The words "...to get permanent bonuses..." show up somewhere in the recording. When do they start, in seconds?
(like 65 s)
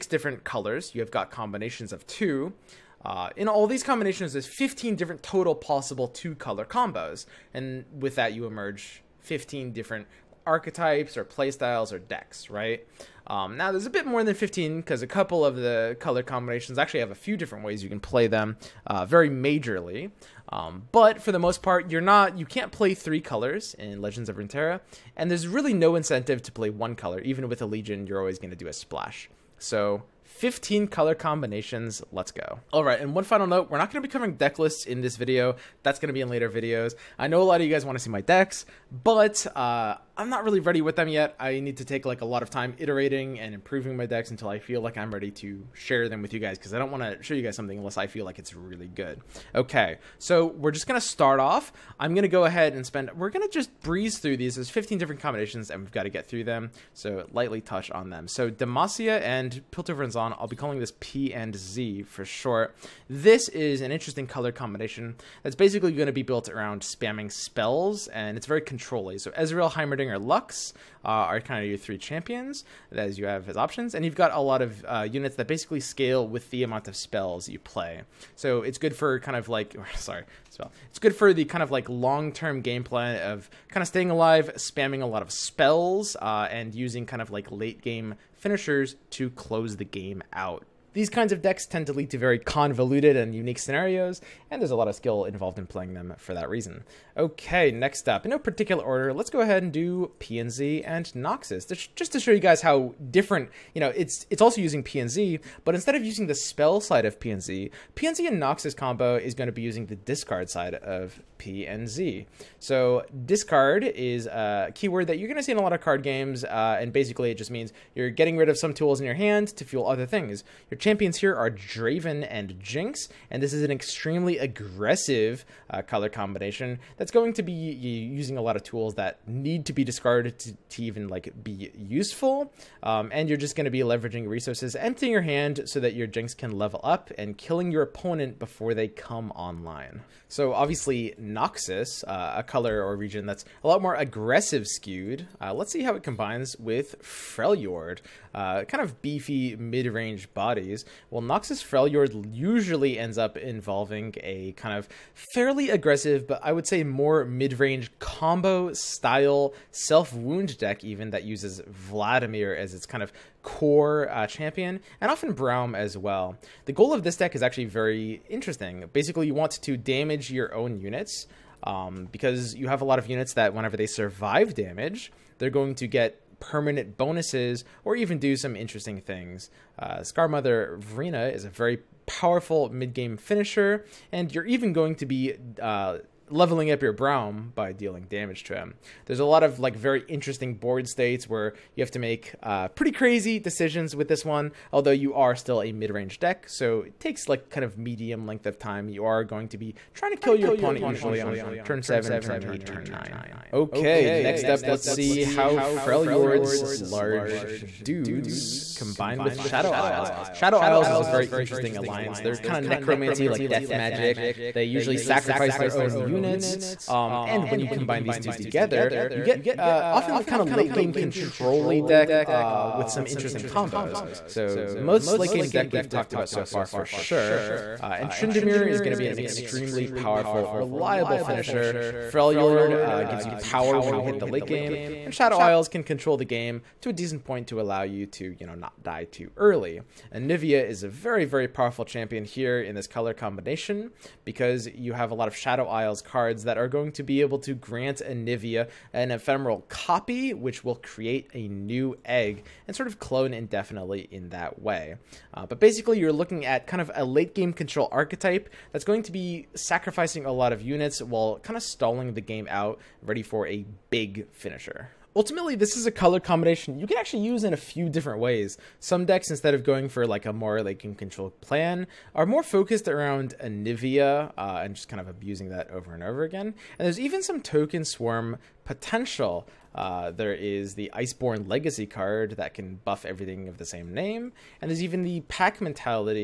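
175 s.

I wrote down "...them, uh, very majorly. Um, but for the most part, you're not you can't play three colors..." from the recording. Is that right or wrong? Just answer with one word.
right.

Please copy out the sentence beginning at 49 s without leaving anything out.
Okay, so we're just gonna start off.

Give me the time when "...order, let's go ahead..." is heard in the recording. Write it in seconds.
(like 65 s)
98 s.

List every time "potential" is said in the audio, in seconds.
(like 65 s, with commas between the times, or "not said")
278 s.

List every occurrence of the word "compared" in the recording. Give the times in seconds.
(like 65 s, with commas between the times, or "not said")
not said.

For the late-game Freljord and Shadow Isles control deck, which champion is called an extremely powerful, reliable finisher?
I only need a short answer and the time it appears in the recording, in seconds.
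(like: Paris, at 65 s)
Tryndamere, at 228 s.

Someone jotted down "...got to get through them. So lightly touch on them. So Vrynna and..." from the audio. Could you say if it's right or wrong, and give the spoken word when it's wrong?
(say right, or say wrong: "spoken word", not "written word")
wrong: "Demacia", not "Vrynna".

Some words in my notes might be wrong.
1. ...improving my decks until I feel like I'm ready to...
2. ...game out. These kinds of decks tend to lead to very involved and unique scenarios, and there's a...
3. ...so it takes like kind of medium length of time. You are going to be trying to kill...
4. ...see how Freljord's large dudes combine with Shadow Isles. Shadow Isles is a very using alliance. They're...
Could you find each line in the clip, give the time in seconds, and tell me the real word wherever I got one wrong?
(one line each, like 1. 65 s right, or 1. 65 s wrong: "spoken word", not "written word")
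1. 43 s right
2. 89 s wrong: "convoluted", not "involved"
3. 196 s right
4. 204 s wrong: "interesting", not "using".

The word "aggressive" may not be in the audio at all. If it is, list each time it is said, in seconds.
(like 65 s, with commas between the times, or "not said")
124 s, 143 s, 155 s.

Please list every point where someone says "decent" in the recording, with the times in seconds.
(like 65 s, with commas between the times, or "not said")
236 s.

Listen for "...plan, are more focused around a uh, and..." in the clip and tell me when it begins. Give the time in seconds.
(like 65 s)
271 s.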